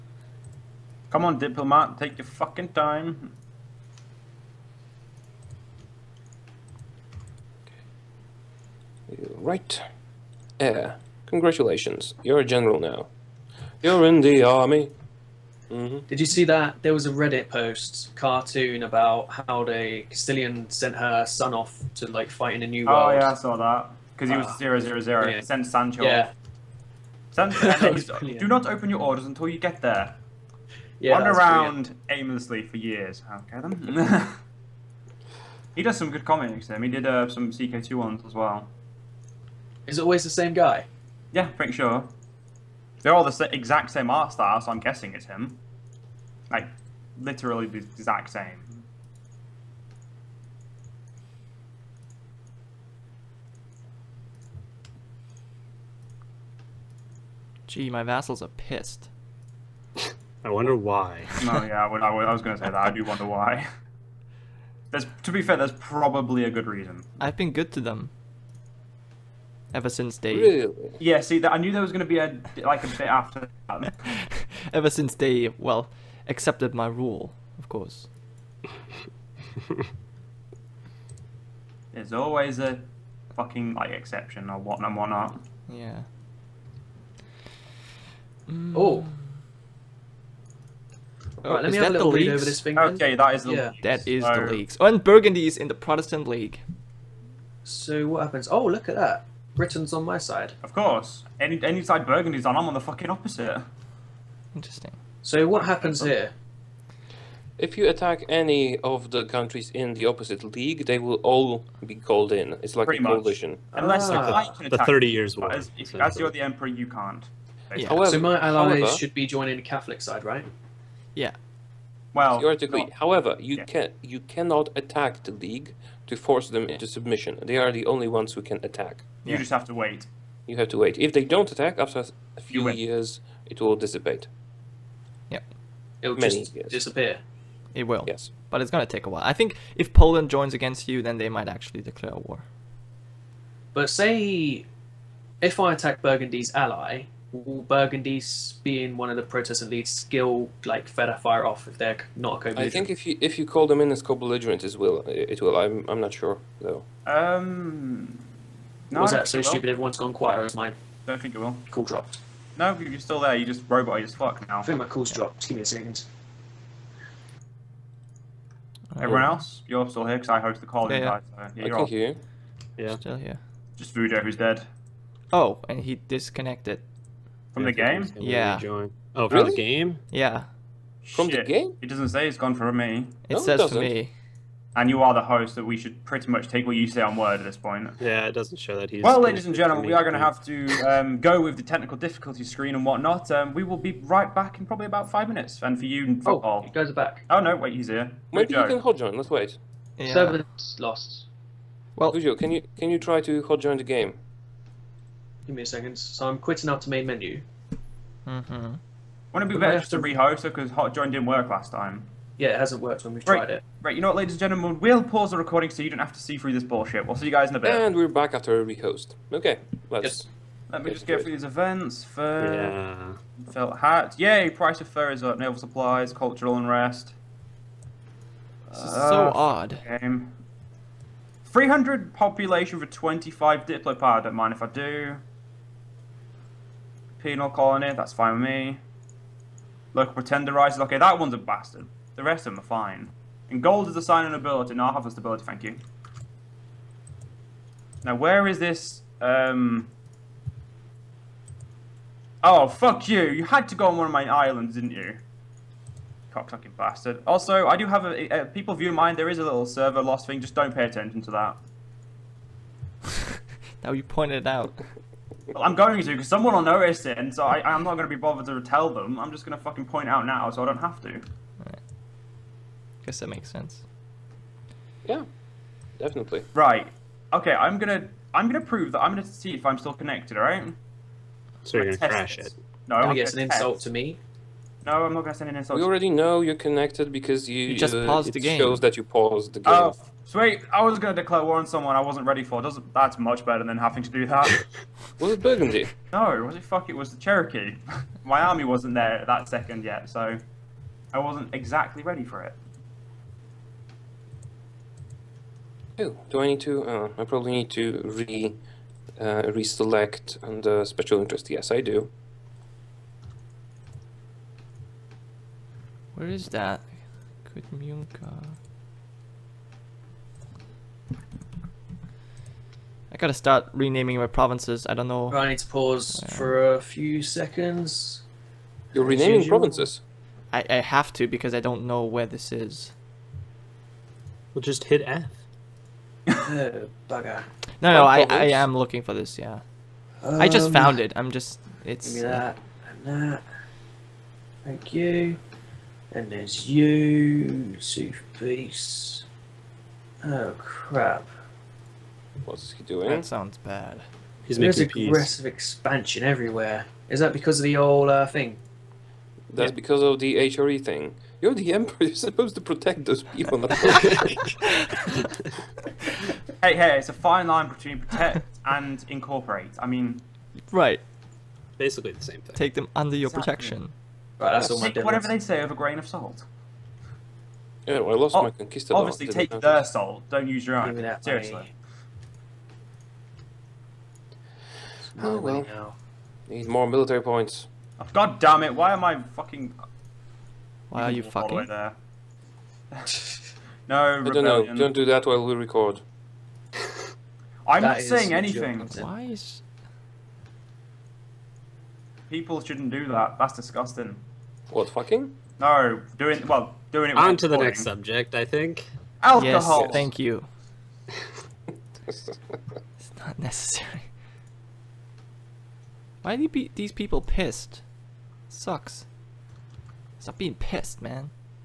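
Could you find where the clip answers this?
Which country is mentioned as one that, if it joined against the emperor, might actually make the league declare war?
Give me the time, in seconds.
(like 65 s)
139 s.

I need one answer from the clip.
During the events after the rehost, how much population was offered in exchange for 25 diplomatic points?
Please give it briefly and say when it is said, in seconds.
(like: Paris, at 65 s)
300, at 231 s.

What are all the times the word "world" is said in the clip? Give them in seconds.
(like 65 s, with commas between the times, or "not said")
22 s.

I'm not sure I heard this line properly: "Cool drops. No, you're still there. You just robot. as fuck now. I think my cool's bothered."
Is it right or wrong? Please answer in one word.
wrong.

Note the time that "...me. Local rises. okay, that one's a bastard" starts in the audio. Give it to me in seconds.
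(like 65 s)
238 s.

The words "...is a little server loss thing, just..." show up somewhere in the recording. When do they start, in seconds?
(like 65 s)
259 s.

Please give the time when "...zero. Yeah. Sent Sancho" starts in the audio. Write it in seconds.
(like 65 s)
25 s.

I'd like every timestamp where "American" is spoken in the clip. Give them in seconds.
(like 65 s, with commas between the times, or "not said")
not said.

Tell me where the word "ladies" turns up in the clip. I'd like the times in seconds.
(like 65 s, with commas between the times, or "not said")
189 s, 214 s.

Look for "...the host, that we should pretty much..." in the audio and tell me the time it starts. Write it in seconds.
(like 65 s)
185 s.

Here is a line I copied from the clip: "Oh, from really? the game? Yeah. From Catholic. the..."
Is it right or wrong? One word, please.
wrong.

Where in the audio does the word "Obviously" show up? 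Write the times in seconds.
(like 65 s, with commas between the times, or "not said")
378 s.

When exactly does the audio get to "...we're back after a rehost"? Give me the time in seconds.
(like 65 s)
217 s.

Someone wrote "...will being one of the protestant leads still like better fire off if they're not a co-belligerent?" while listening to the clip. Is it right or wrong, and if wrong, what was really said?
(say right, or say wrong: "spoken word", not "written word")
wrong: "feather", not "better".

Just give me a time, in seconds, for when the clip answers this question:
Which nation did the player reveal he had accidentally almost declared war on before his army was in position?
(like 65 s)
297 s.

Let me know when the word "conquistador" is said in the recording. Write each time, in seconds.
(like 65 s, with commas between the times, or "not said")
378 s.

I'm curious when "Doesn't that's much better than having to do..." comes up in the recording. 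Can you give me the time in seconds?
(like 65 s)
292 s.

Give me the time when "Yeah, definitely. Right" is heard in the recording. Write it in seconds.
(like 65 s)
275 s.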